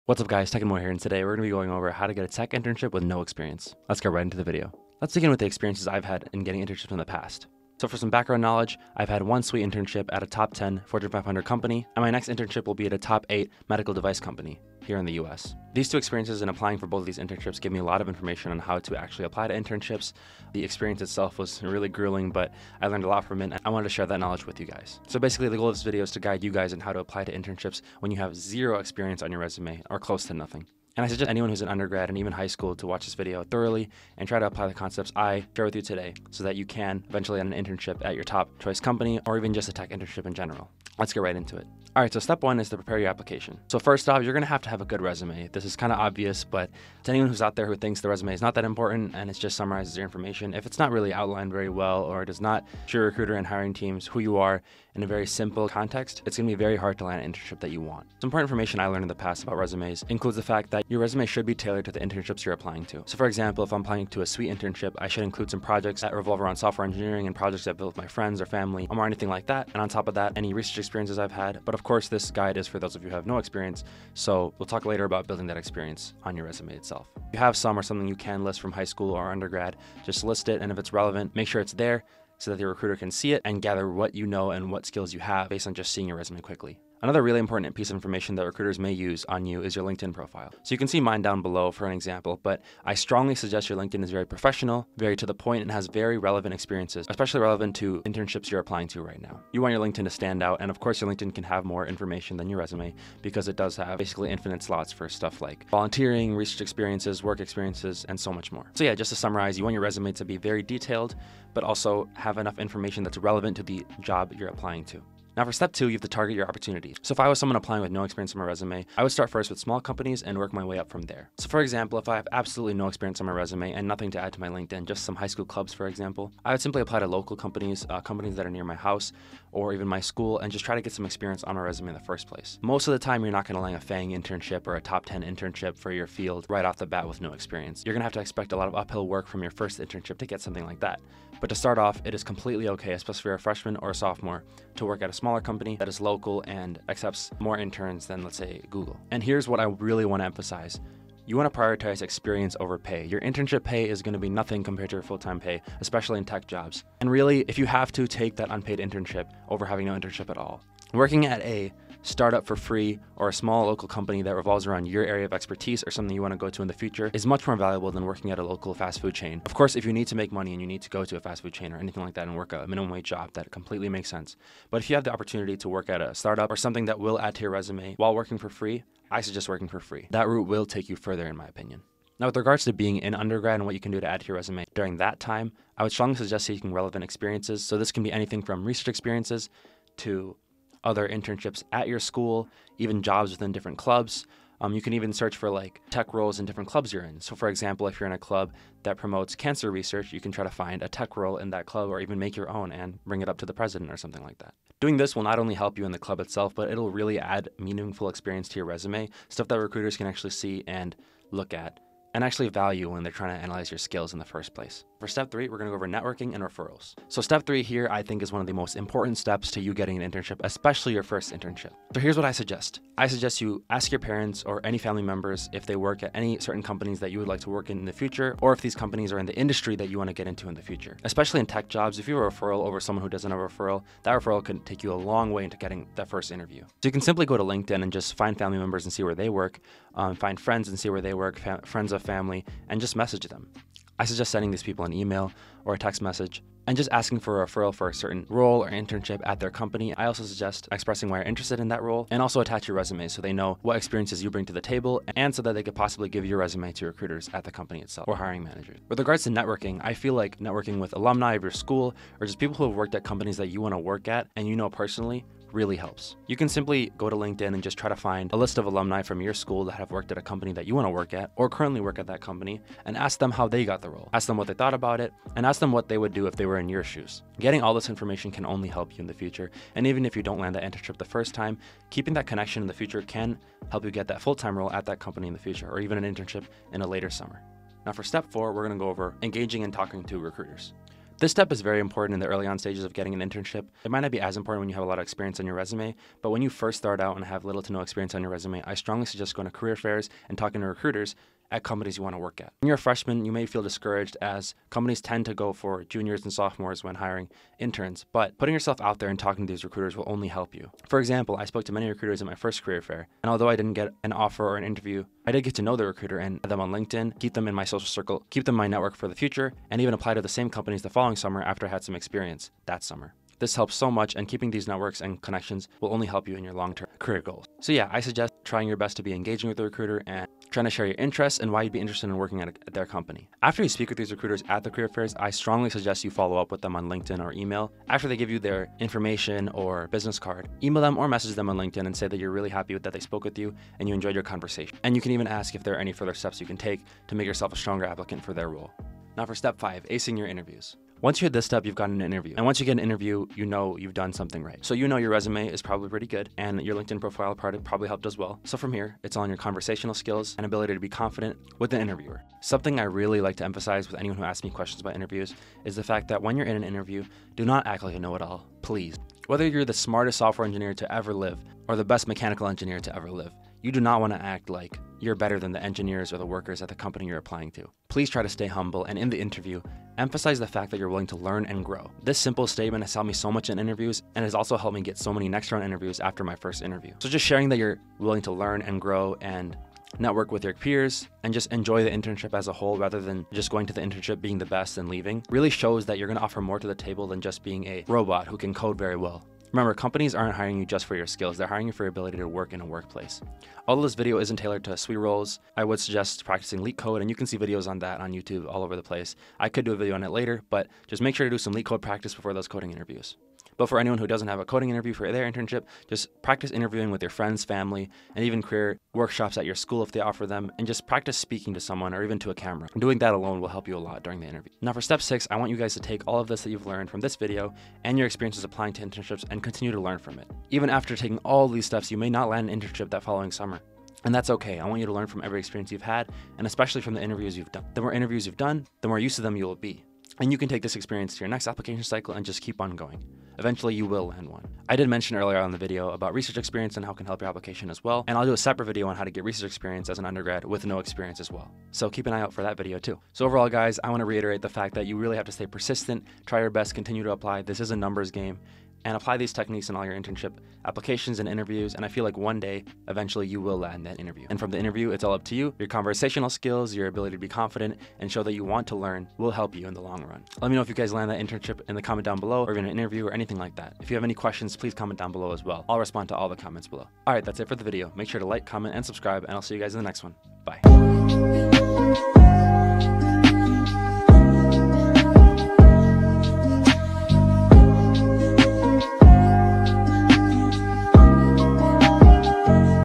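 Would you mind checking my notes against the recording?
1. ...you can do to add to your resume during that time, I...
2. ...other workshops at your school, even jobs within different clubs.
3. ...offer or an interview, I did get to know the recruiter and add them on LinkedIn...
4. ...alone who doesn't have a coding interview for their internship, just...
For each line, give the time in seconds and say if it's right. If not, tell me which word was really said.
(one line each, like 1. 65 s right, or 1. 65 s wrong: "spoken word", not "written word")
1. 183 s right
2. 190 s wrong: "internships", not "workshops"
3. 314 s right
4. 413 s wrong: "anyone", not "alone".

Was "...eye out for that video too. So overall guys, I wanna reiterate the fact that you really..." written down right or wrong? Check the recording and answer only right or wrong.
right.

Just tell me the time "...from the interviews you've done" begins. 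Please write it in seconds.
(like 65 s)
436 s.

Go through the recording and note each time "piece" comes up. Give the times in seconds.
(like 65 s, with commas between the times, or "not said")
87 s.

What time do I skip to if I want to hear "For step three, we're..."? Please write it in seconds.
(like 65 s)
214 s.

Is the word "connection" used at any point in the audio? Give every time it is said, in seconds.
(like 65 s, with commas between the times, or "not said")
282 s, 325 s.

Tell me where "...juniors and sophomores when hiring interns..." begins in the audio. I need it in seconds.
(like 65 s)
305 s.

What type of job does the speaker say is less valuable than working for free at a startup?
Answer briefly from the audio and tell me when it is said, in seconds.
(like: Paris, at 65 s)
Local fast food chain, at 168 s.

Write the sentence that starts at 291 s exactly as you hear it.
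This step is very important in the early on stages of getting an internship.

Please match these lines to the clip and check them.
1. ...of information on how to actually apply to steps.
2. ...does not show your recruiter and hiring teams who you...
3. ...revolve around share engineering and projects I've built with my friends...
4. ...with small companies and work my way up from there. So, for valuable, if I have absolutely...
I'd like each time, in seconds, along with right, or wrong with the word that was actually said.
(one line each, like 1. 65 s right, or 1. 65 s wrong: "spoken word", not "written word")
1. 18 s wrong: "internships", not "steps"
2. 52 s right
3. 66 s wrong: "software", not "share"
4. 119 s wrong: "example", not "valuable".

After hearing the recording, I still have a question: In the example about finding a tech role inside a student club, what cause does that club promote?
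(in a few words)
Cancer research.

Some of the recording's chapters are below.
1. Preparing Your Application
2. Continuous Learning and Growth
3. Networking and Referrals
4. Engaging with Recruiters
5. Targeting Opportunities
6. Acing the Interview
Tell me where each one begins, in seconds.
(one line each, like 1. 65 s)
1. 42 s
2. 423 s
3. 212 s
4. 287 s
5. 112 s
6. 348 s.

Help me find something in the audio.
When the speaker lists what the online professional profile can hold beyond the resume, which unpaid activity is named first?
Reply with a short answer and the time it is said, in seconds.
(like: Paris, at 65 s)
Volunteering, at 105 s.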